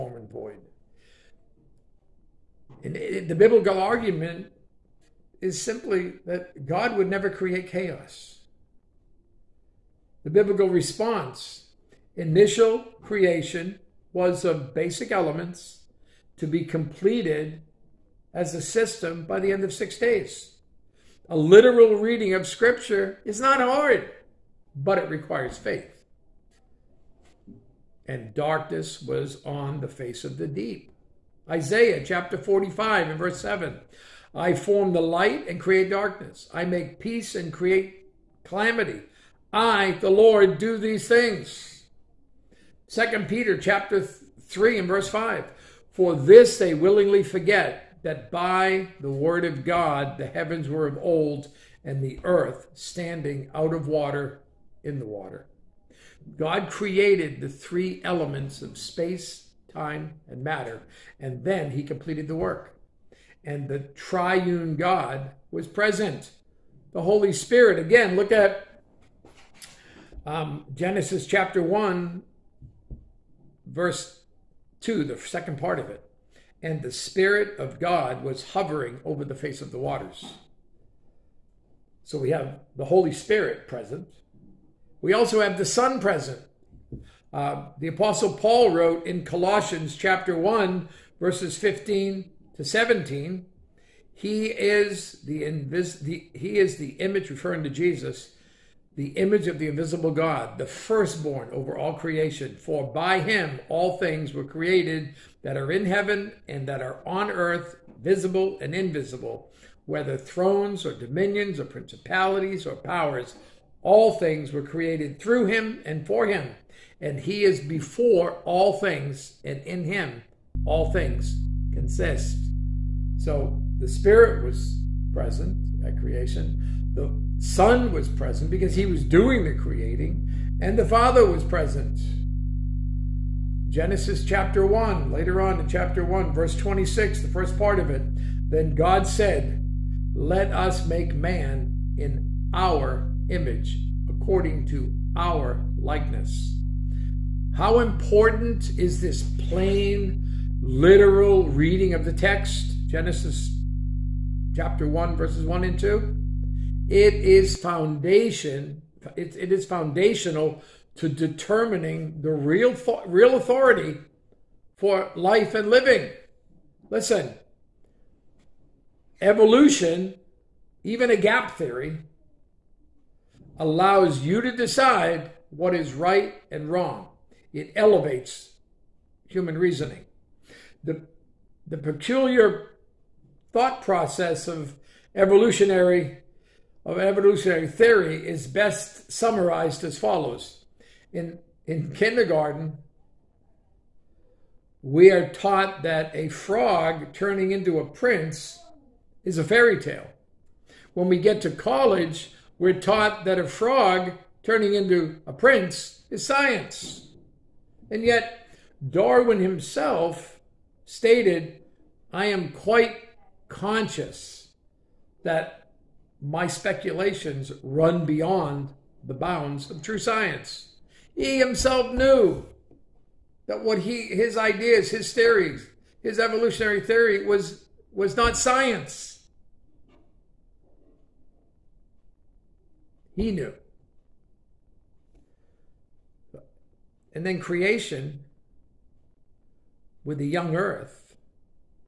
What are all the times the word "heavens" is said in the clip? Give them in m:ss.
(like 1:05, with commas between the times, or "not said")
0:50, 1:45.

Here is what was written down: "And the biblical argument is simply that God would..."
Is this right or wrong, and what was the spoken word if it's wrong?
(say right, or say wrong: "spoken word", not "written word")
right.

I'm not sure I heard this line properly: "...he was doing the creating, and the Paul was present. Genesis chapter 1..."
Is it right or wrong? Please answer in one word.
wrong.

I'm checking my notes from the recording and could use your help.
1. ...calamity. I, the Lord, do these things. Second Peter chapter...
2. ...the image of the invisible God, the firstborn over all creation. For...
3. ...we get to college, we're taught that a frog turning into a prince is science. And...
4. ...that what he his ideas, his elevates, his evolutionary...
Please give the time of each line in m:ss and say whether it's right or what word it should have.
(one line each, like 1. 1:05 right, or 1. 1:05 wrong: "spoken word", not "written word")
1. 0:38 right
2. 1:38 right
3. 3:21 right
4. 3:43 wrong: "theories", not "elevates".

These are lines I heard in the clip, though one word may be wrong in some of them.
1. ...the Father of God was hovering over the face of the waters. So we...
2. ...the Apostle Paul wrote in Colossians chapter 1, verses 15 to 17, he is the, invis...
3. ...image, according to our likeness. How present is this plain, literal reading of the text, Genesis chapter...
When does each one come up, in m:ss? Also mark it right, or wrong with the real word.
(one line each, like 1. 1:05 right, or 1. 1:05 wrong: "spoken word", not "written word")
1. 1:16 wrong: "Spirit", not "Father"
2. 1:27 right
3. 2:23 wrong: "important", not "present".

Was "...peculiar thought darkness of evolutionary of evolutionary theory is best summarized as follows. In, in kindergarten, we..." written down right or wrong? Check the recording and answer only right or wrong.
wrong.